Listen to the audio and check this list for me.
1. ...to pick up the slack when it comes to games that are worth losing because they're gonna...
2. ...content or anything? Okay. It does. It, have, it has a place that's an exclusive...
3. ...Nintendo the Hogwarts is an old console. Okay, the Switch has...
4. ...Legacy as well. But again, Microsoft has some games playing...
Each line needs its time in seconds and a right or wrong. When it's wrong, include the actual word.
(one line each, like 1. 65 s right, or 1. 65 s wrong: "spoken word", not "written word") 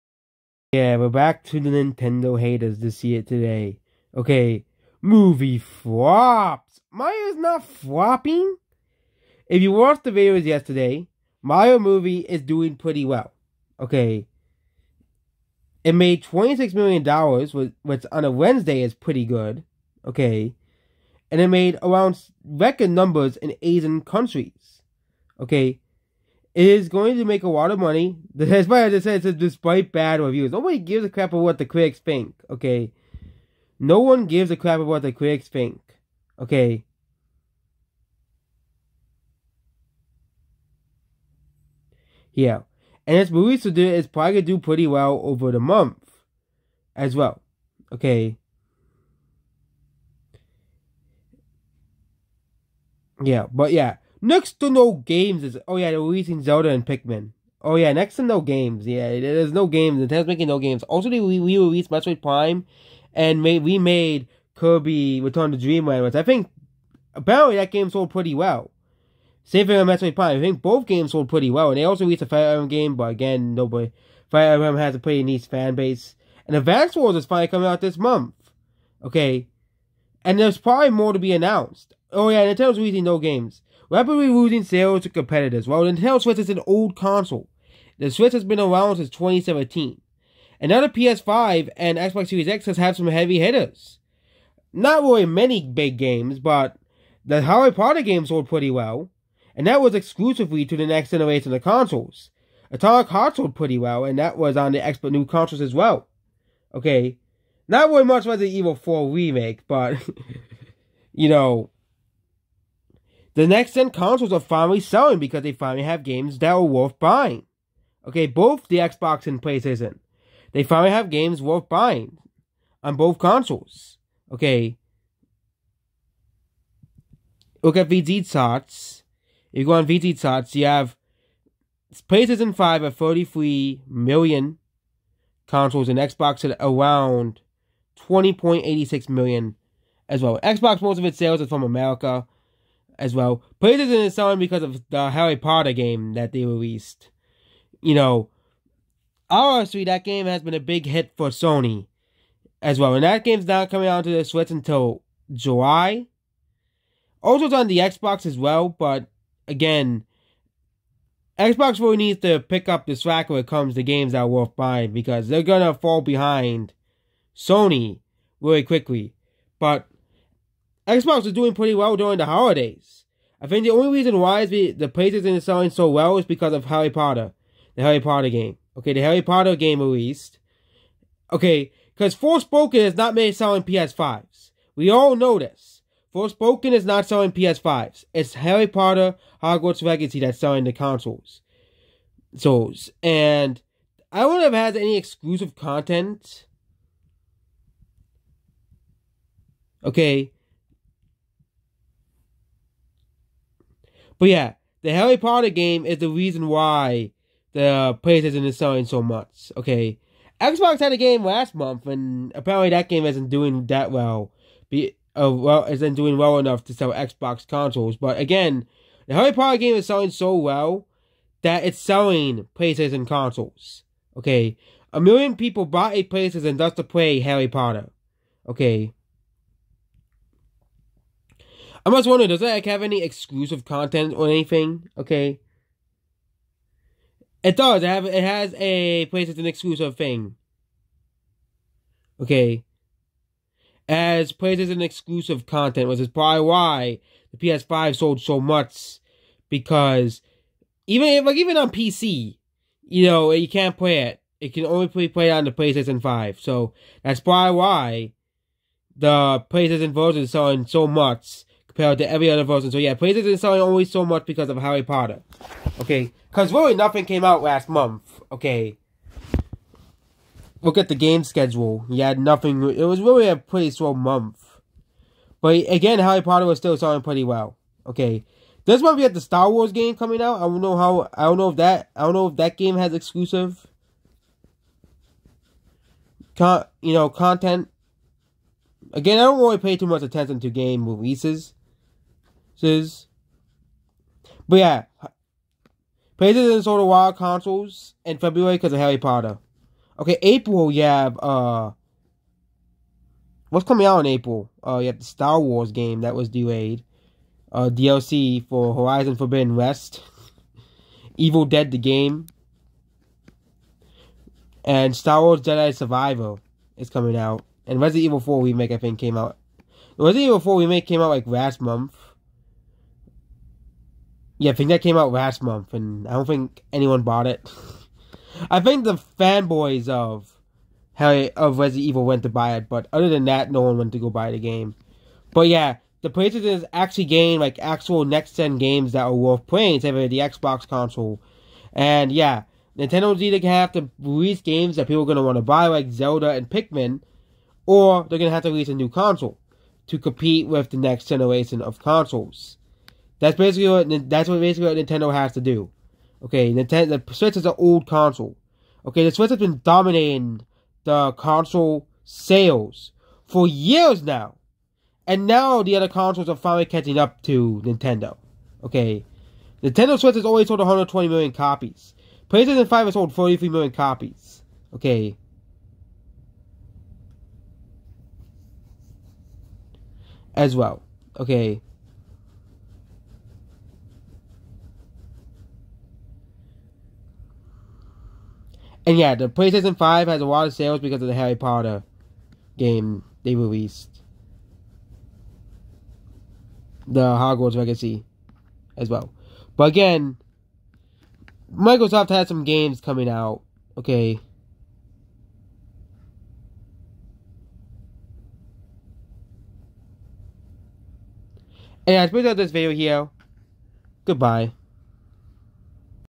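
1. 162 s wrong: "buying", not "losing"
2. 233 s right
3. 356 s wrong: "Switch", not "Hogwarts"
4. 397 s wrong: "coming", not "playing".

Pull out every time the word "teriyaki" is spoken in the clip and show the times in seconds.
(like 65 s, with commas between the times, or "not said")
not said.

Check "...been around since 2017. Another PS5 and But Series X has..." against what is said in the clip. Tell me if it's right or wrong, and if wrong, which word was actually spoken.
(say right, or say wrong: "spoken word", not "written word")
wrong: "Xbox", not "But".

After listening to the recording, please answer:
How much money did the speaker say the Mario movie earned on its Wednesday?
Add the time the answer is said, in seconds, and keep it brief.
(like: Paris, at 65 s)
$26 million, at 16 s.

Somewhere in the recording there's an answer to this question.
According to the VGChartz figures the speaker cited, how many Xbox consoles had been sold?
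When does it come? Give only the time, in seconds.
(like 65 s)
137 s.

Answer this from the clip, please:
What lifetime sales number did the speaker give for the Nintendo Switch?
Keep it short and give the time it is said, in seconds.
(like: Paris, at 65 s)
120 million, at 370 s.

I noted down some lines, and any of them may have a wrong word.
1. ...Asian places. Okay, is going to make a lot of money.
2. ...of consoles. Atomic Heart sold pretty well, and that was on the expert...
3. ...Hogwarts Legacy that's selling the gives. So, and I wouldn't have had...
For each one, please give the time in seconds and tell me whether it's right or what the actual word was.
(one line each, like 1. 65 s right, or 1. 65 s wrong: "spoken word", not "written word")
1. 23 s wrong: "countries", not "places"
2. 101 s right
3. 189 s wrong: "consoles", not "gives".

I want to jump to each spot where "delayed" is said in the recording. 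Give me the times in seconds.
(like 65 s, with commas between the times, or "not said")
306 s.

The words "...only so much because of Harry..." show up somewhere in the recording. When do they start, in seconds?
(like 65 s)
263 s.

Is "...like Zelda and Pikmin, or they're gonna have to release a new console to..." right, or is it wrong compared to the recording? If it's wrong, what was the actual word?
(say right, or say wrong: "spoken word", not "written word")
right.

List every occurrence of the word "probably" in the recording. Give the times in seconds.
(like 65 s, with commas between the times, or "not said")
44 s, 80 s, 246 s, 257 s.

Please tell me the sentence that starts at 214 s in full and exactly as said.
Be uh, well isn't doing well enough to sell Xbox consoles.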